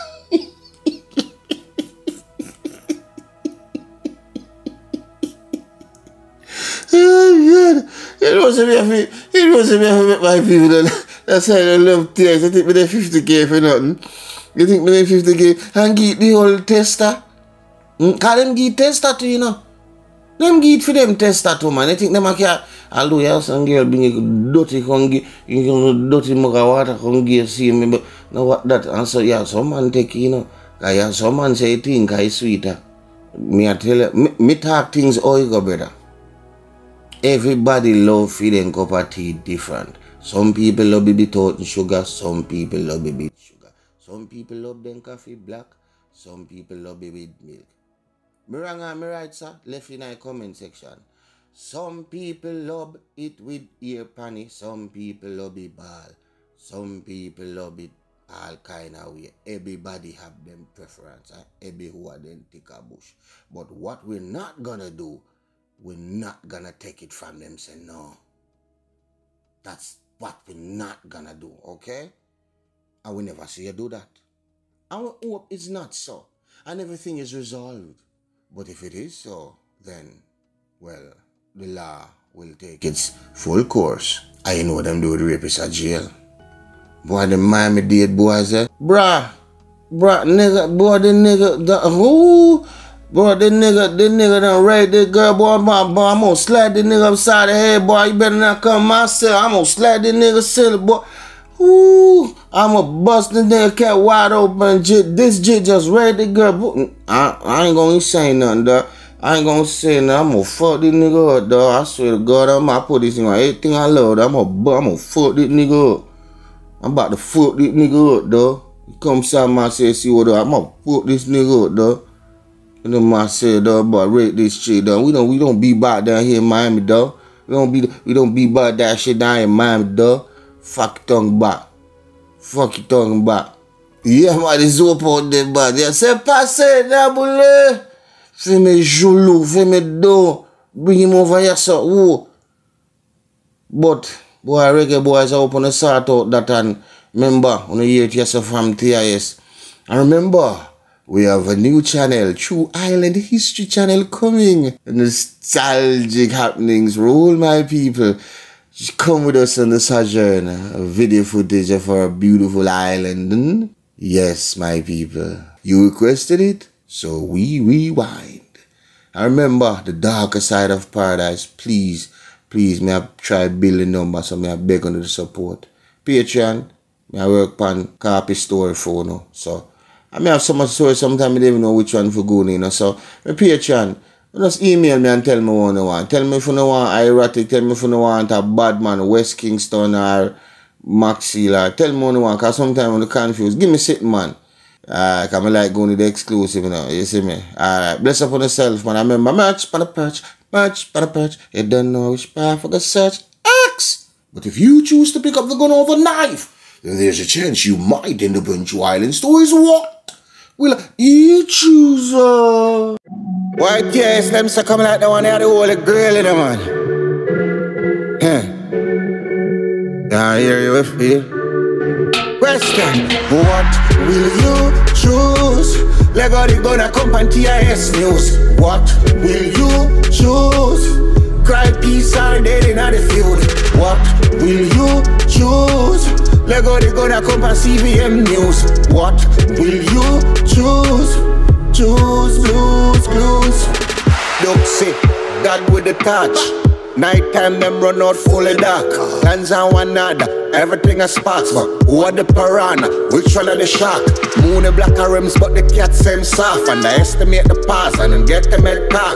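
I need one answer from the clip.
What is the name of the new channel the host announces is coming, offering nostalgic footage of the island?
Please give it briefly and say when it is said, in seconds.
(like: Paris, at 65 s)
True Island History Channel, at 152 s.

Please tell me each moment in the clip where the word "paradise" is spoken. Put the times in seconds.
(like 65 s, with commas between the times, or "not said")
170 s.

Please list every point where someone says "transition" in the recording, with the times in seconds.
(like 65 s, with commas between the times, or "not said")
not said.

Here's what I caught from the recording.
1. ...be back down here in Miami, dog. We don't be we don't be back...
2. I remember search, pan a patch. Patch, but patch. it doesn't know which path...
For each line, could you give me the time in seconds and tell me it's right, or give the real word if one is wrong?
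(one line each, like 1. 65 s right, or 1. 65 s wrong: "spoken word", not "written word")
1. 125 s right
2. 198 s wrong: "match", not "search".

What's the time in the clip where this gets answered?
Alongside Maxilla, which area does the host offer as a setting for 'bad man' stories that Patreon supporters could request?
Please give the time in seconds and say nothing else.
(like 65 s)
189 s.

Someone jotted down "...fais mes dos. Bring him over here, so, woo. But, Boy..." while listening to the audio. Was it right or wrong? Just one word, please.
right.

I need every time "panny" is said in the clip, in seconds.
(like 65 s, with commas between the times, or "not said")
54 s.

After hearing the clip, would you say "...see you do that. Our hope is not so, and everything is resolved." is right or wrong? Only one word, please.
right.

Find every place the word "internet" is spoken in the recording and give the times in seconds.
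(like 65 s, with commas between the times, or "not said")
not said.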